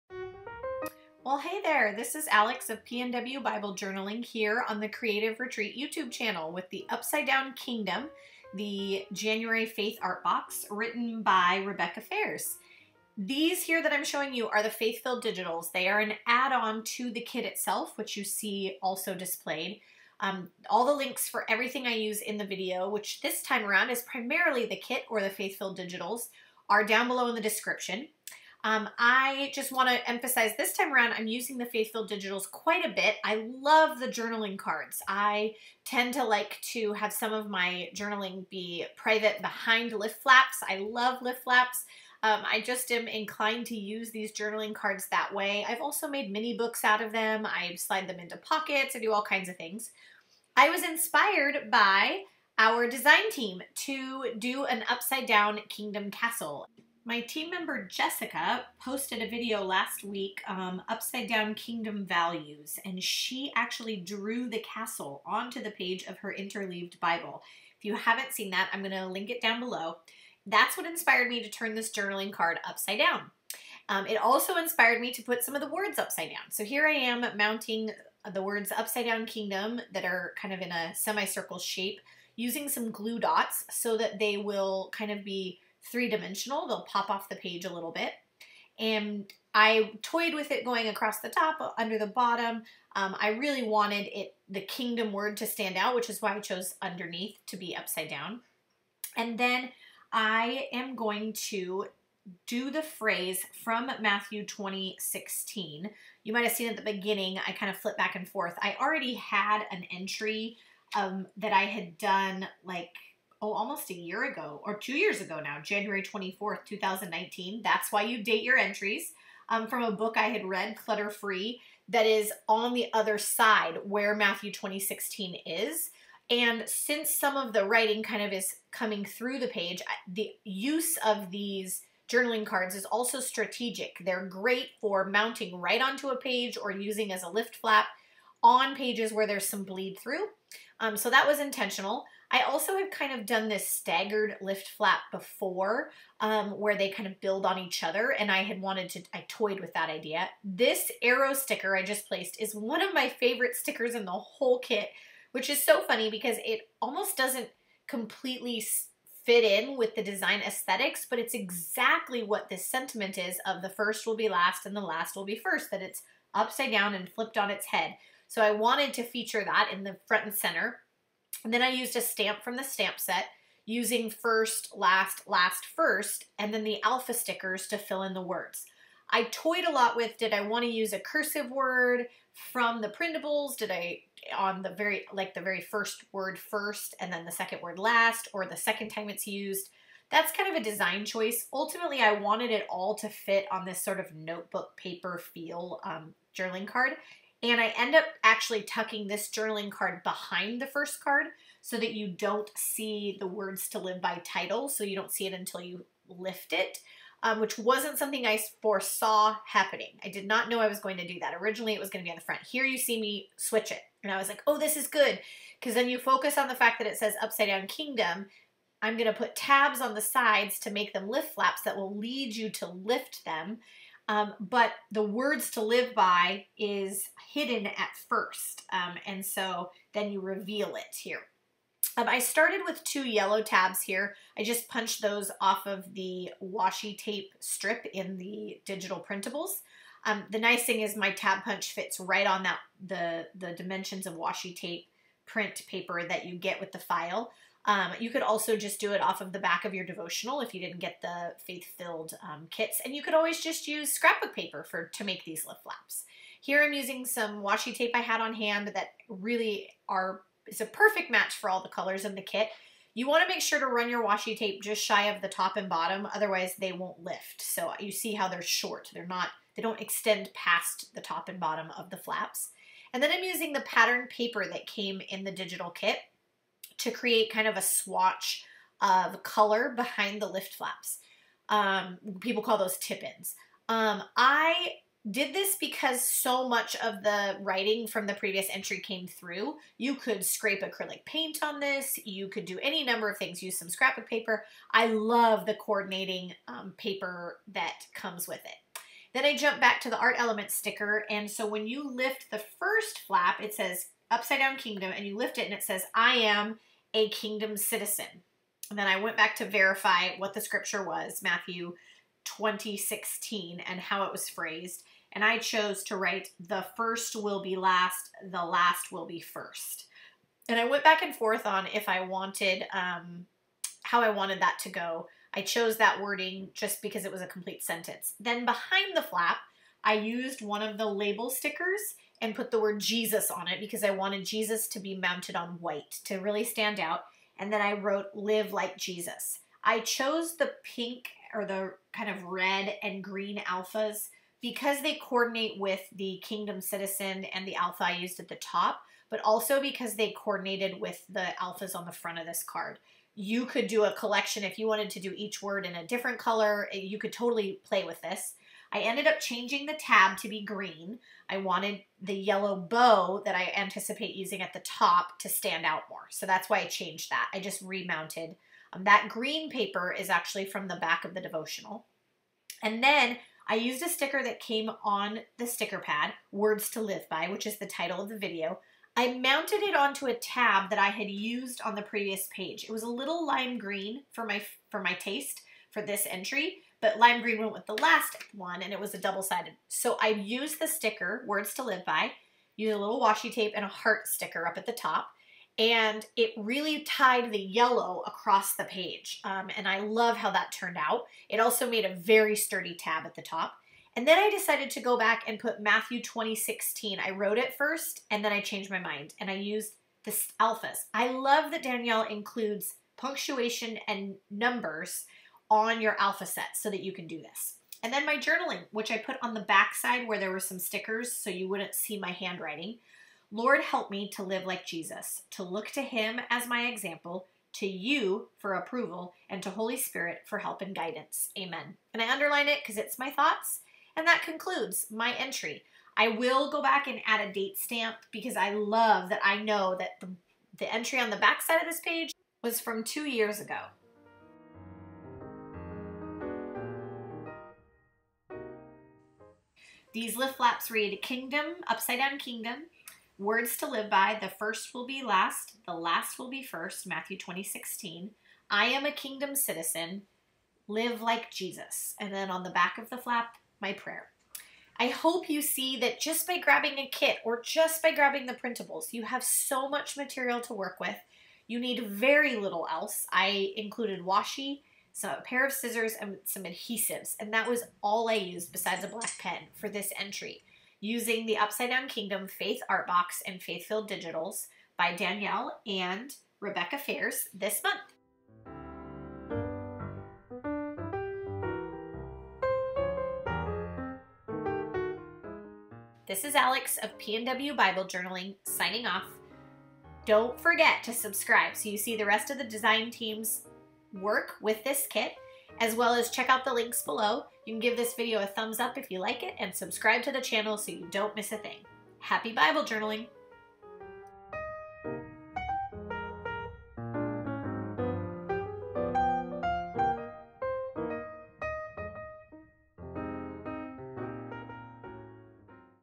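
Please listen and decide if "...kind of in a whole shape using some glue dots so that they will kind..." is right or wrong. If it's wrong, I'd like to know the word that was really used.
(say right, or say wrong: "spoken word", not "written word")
wrong: "semicircle", not "whole".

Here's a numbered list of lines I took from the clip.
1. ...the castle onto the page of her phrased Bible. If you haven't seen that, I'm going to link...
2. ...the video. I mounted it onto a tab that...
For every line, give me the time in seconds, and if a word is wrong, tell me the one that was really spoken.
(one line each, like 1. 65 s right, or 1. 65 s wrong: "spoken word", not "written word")
1. 64 s wrong: "interleaved", not "phrased"
2. 378 s right.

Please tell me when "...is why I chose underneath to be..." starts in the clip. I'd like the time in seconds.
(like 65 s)
96 s.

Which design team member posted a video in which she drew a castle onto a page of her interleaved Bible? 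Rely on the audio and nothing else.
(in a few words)
Jessica.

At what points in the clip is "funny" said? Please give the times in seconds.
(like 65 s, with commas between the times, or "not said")
155 s.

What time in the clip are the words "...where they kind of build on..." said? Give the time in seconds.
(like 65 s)
146 s.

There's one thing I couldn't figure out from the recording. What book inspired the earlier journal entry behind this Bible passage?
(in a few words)
Clutter Free.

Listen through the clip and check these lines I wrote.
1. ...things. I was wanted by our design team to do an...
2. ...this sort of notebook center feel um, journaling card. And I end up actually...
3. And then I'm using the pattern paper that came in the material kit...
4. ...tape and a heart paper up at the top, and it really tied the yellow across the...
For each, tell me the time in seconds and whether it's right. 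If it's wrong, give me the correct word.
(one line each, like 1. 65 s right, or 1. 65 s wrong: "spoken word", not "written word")
1. 49 s wrong: "inspired", not "wanted"
2. 193 s wrong: "paper", not "center"
3. 272 s wrong: "digital", not "material"
4. 393 s wrong: "sticker", not "paper".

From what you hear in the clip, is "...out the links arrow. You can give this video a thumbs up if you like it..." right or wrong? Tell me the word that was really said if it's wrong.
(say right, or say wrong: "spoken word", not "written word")
wrong: "below", not "arrow".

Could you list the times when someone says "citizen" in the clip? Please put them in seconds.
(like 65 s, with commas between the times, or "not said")
307 s, 346 s, 459 s.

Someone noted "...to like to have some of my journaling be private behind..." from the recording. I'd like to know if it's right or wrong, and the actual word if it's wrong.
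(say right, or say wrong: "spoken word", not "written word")
right.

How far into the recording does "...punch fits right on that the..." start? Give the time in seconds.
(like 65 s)
241 s.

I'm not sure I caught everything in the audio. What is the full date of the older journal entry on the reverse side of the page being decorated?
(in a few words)
January 24th, 2019.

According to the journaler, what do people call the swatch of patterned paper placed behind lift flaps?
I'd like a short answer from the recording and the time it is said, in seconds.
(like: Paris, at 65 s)
tip-ins, at 282 s.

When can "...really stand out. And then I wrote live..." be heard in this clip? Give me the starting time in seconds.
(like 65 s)
336 s.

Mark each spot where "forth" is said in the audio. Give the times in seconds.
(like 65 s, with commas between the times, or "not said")
108 s, 321 s.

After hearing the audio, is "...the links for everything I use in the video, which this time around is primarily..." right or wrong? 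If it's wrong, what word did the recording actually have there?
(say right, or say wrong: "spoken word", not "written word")
right.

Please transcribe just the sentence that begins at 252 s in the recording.
And you could always just use scrapbook paper for to make these lift flaps.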